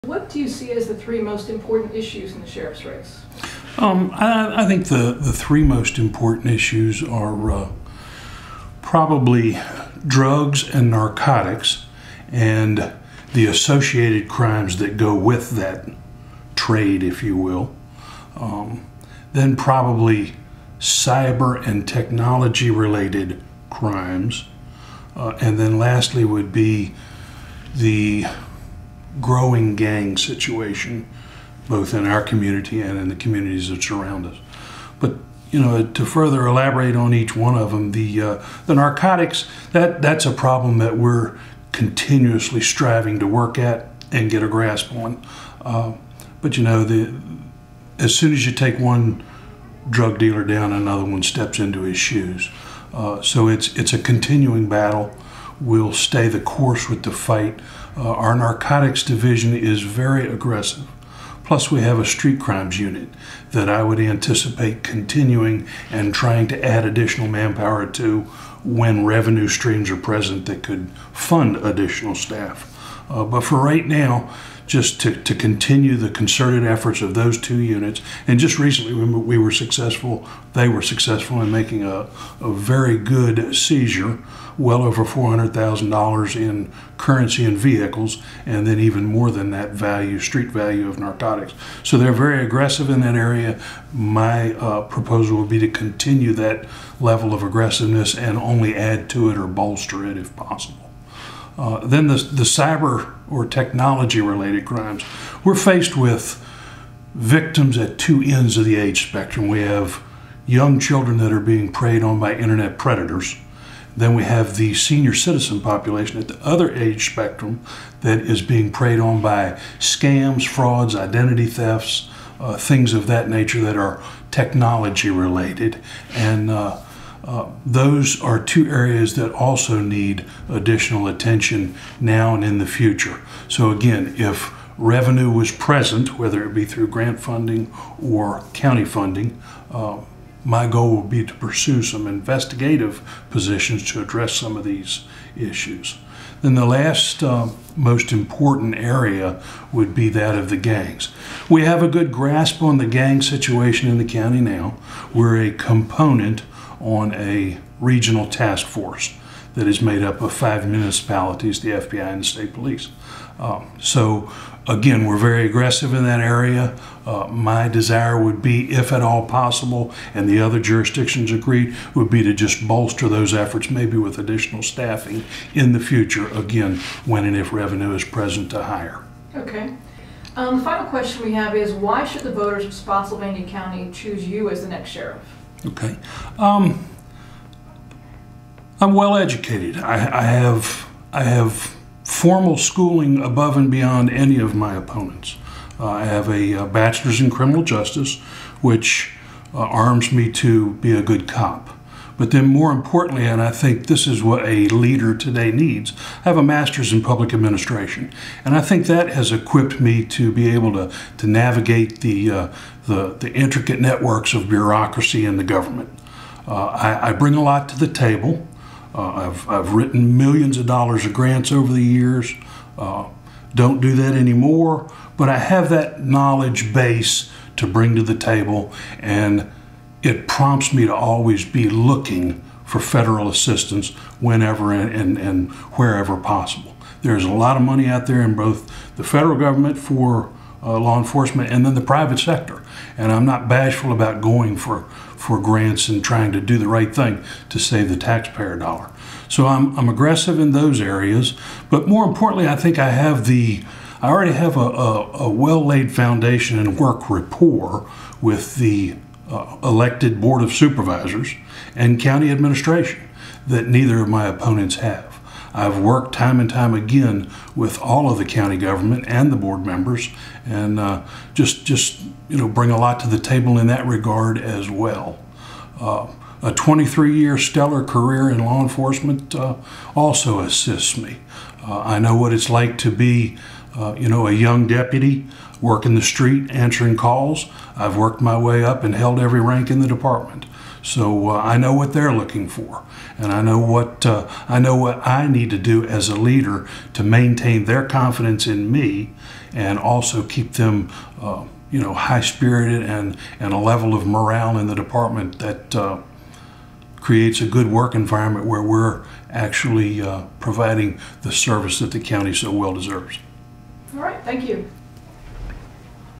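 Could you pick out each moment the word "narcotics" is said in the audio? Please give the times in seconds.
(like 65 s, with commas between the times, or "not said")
10 s, 38 s, 58 s, 90 s.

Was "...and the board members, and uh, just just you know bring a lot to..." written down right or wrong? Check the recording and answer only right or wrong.
right.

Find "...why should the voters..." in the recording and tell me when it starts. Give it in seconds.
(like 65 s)
181 s.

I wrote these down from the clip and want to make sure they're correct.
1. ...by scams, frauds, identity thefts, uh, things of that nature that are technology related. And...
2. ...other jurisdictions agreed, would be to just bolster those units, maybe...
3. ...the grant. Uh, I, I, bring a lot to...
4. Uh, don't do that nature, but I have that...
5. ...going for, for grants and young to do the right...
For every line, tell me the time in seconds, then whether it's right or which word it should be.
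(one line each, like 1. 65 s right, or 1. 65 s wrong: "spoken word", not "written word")
1. 119 s right
2. 170 s wrong: "efforts", not "units"
3. 215 s wrong: "government", not "grant"
4. 222 s wrong: "anymore", not "nature"
5. 244 s wrong: "trying", not "young".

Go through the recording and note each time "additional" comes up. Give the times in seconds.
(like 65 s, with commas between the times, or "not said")
66 s, 71 s, 130 s, 174 s.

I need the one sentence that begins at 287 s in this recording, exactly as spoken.
I've worked my way up and held every rank in the department.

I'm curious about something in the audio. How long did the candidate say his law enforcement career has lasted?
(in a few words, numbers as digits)
23 years.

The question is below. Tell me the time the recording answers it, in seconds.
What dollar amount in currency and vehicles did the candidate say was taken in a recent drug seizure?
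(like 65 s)
84 s.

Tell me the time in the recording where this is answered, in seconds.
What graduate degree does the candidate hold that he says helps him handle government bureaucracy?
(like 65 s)
206 s.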